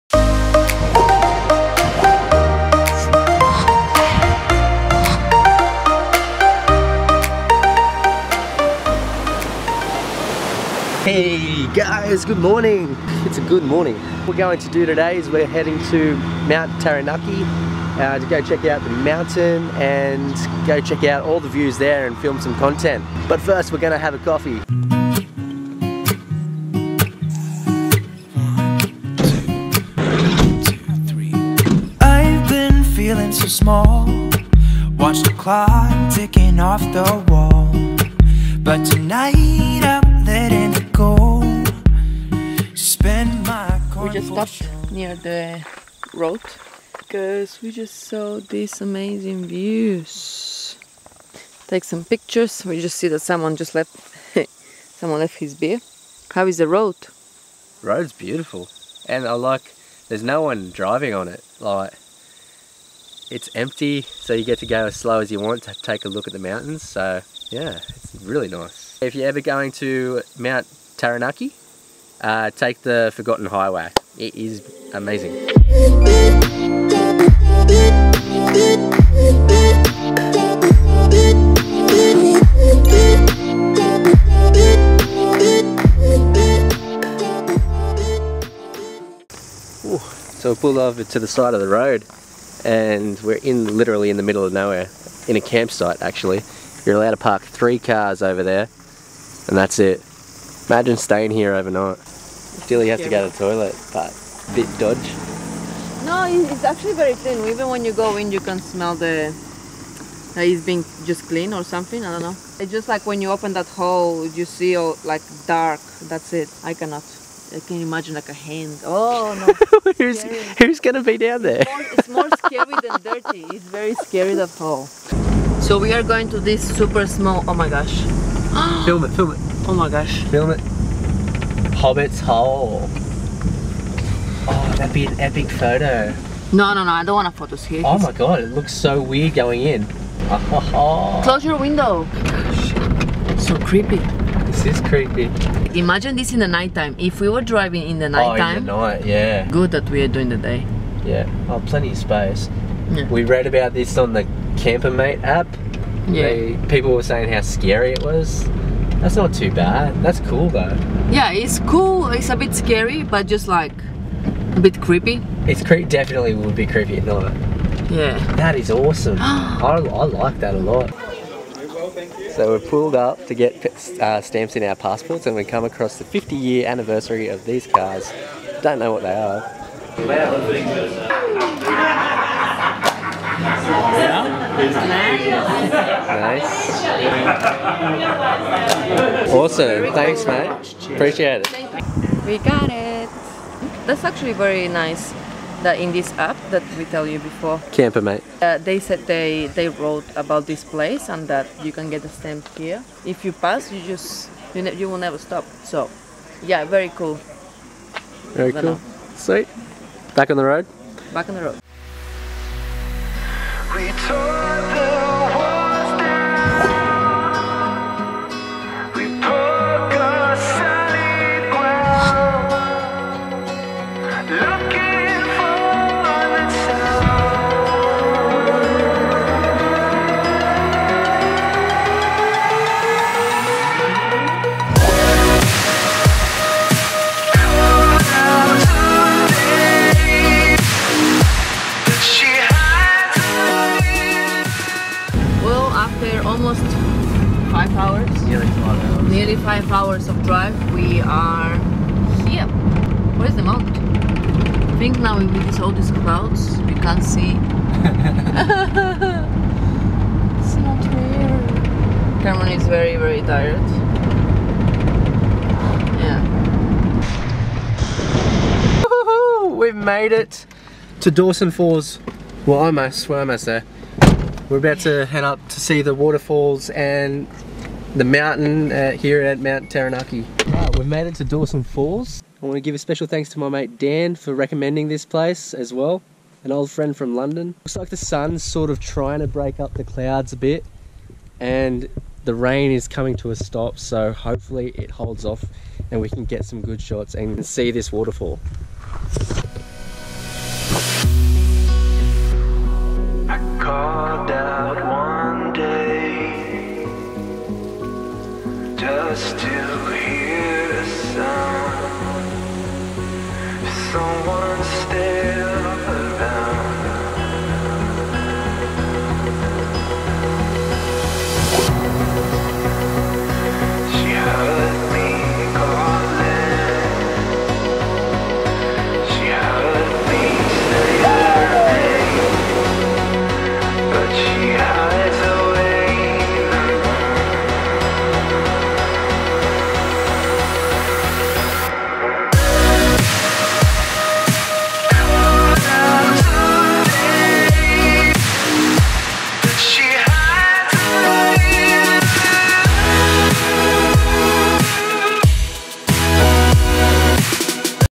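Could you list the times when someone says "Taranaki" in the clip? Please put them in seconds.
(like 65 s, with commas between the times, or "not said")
16 s, 70 s, 279 s.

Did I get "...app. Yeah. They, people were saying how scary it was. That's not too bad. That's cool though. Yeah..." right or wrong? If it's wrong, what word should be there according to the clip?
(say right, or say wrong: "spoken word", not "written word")
right.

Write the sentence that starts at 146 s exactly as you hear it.
If we were driving in the nighttime.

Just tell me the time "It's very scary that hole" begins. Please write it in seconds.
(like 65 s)
123 s.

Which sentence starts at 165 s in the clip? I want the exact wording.
It's cre definitely would be creepy at night.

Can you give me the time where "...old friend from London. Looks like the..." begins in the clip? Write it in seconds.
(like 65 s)
286 s.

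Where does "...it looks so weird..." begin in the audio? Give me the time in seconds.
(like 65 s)
138 s.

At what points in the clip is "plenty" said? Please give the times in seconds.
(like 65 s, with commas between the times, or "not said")
151 s.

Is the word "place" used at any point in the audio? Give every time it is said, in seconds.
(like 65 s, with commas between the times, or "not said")
200 s, 285 s.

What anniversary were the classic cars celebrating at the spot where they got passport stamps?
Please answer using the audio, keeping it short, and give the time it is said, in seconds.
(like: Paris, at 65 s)
50 year anniversary, at 176 s.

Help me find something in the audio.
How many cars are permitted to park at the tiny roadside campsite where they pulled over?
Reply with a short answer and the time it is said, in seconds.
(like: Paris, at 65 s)
3, at 97 s.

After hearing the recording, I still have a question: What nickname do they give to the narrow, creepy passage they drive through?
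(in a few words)
Hobbit's Hole.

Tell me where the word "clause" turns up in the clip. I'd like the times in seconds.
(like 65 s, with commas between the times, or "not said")
not said.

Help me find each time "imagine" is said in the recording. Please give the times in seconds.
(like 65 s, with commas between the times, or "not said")
100 s, 117 s, 145 s.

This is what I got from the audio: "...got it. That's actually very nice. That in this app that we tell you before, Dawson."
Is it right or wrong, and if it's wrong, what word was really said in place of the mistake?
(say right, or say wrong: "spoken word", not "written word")
wrong: "Campermate", not "Dawson".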